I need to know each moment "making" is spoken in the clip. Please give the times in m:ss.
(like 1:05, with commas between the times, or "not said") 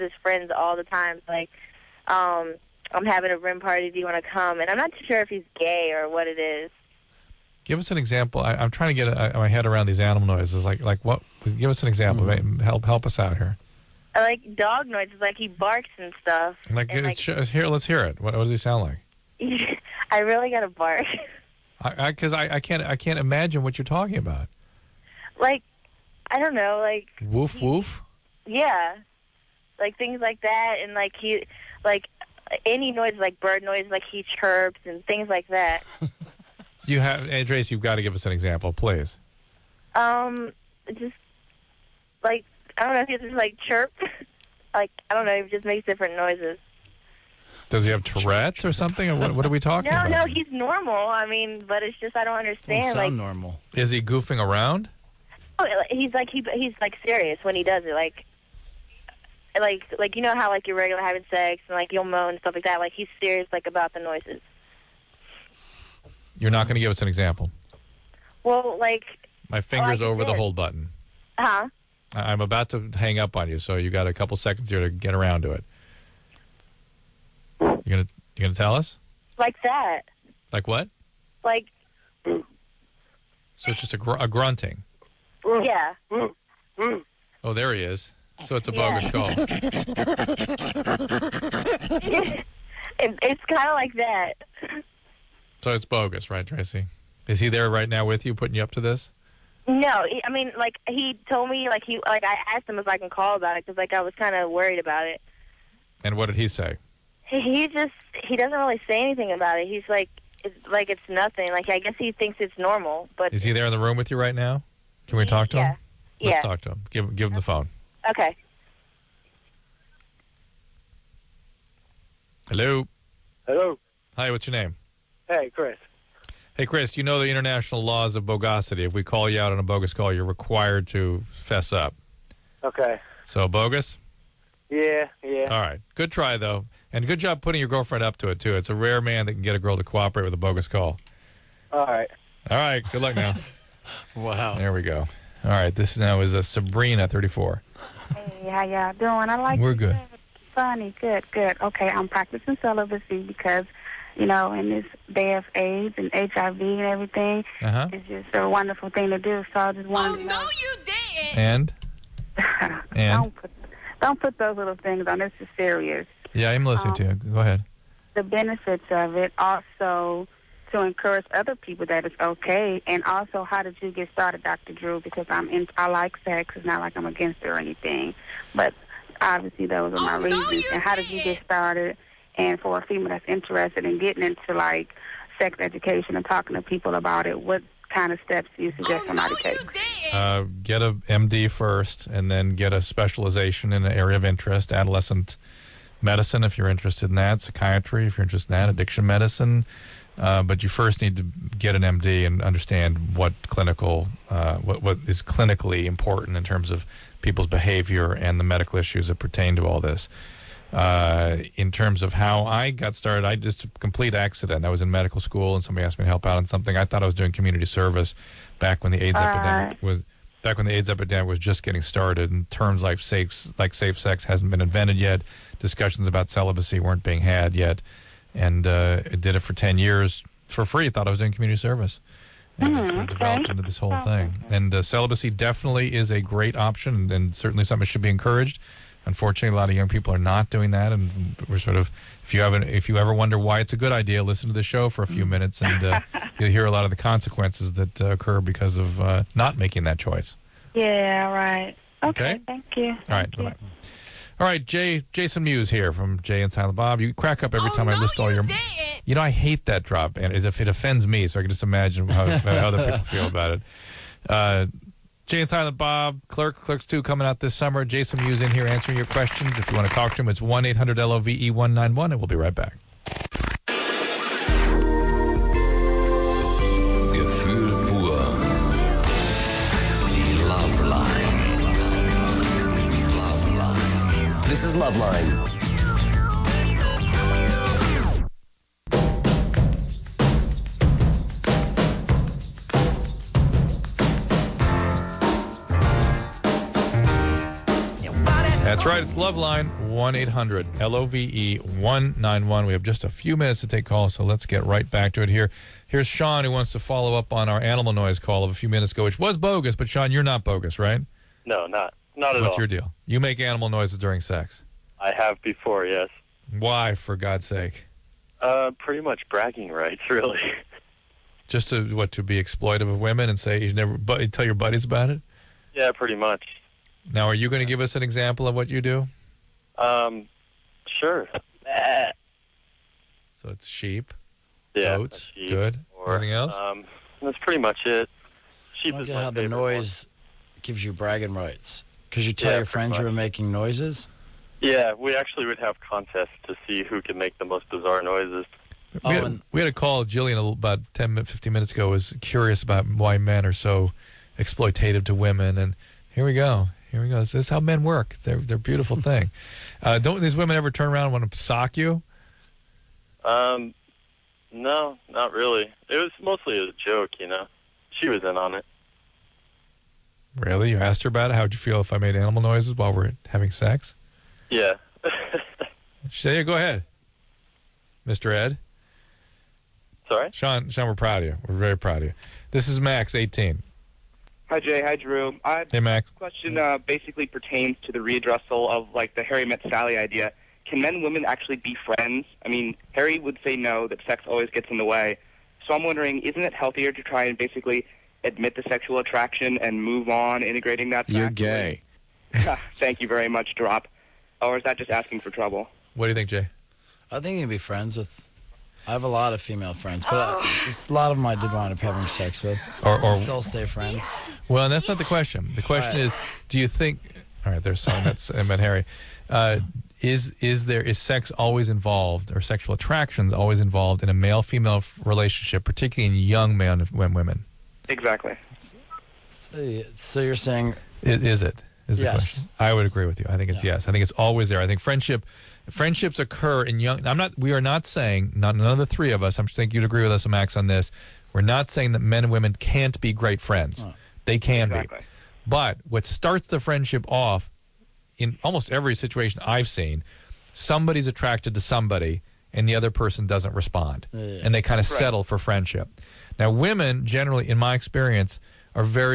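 4:09, 5:43.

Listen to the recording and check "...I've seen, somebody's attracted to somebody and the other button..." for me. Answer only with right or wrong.
wrong.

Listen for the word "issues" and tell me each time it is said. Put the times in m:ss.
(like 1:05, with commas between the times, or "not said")
3:28.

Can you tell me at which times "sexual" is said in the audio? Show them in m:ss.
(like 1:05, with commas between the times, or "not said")
6:38, 7:02.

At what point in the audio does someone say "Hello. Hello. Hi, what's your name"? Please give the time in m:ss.
2:02.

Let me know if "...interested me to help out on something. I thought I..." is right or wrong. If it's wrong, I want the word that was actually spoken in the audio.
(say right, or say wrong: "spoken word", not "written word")
wrong: "asked", not "interested".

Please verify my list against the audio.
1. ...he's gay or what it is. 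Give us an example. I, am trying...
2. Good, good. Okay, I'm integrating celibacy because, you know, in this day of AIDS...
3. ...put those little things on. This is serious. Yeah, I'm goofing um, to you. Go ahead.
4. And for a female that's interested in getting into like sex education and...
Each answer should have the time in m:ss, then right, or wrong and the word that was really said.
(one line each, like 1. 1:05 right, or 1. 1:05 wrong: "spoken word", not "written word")
1. 0:05 right
2. 2:31 wrong: "practicing", not "integrating"
3. 2:44 wrong: "listening", not "goofing"
4. 3:02 right.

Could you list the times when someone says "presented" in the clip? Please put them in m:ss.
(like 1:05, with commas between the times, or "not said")
not said.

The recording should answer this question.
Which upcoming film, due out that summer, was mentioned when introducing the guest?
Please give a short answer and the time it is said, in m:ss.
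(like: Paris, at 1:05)
Clerks 2, at 4:26.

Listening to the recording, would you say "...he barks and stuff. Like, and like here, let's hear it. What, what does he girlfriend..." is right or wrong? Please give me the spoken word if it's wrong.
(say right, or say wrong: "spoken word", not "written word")
wrong: "sound", not "girlfriend".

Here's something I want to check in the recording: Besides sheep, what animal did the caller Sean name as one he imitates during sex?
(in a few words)
Goats.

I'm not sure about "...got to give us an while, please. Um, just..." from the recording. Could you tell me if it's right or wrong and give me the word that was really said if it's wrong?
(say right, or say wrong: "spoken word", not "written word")
wrong: "example", not "while".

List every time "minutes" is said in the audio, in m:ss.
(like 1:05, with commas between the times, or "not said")
4:05, 5:03, 5:08, 5:51.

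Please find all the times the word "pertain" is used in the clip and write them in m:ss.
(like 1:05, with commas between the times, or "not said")
3:29, 6:27.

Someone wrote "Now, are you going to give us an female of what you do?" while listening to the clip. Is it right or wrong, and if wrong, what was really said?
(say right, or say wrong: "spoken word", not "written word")
wrong: "example", not "female".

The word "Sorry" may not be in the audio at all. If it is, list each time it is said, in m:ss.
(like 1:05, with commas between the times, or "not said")
6:20.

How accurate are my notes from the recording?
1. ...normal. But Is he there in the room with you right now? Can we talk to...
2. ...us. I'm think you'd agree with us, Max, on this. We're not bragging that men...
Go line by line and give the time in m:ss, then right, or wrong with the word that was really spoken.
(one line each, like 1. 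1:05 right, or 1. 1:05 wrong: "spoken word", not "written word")
1. 1:52 right
2. 7:19 wrong: "saying", not "bragging".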